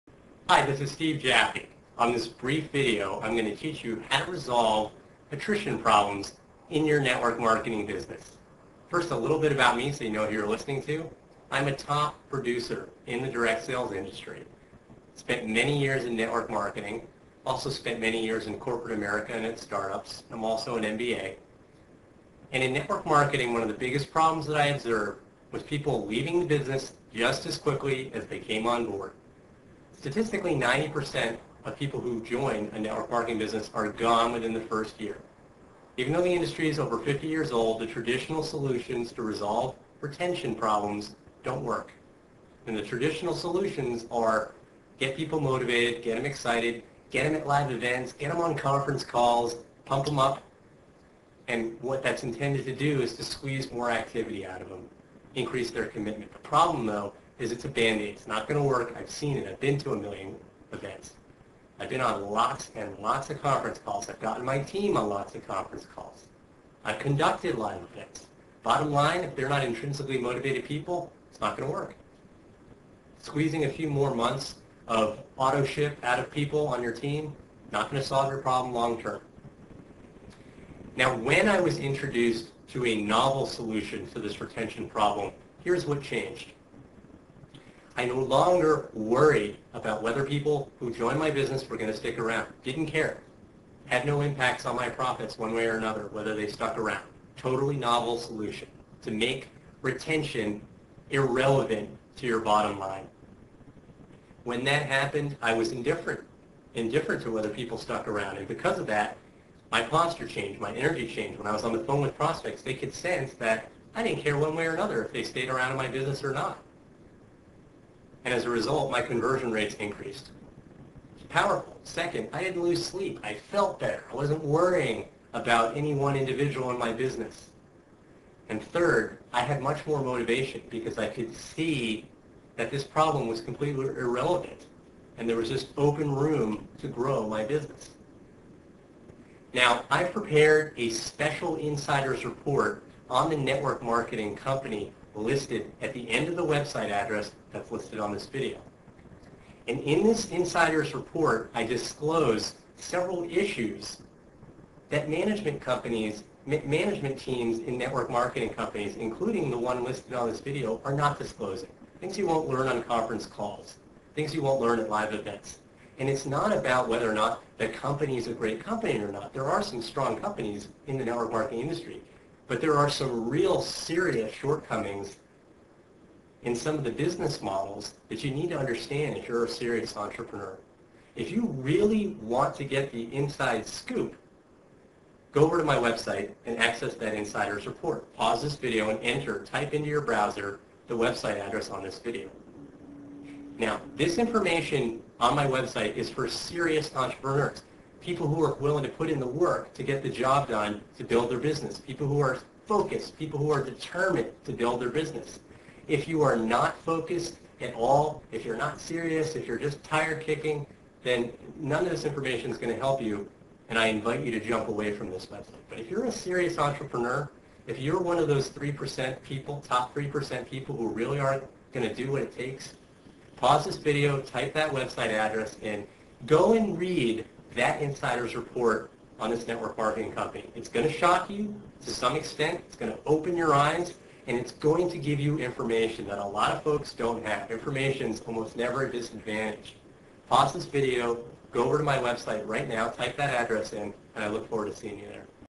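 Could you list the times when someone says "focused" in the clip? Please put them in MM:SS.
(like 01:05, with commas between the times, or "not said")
03:22, 03:26.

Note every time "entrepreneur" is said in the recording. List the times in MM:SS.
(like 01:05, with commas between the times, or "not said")
02:59, 03:16, 03:36.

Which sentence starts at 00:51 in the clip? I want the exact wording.
And what that's intended to do is to squeeze more activity out of them, increase their commitment.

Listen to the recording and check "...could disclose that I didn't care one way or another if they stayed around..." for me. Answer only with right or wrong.
wrong.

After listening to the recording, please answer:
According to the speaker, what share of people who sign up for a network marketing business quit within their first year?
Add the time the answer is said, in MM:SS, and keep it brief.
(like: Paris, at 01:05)
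90%, at 00:30.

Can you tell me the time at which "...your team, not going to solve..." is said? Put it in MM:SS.
01:16.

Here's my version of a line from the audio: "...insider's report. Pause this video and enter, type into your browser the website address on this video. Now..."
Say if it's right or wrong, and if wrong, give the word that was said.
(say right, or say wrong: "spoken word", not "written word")
right.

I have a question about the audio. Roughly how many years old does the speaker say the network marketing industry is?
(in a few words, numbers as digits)
over 50 years.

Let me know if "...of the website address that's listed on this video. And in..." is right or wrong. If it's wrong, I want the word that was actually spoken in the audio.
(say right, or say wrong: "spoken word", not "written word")
right.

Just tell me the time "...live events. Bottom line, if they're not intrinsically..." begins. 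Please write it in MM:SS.
01:07.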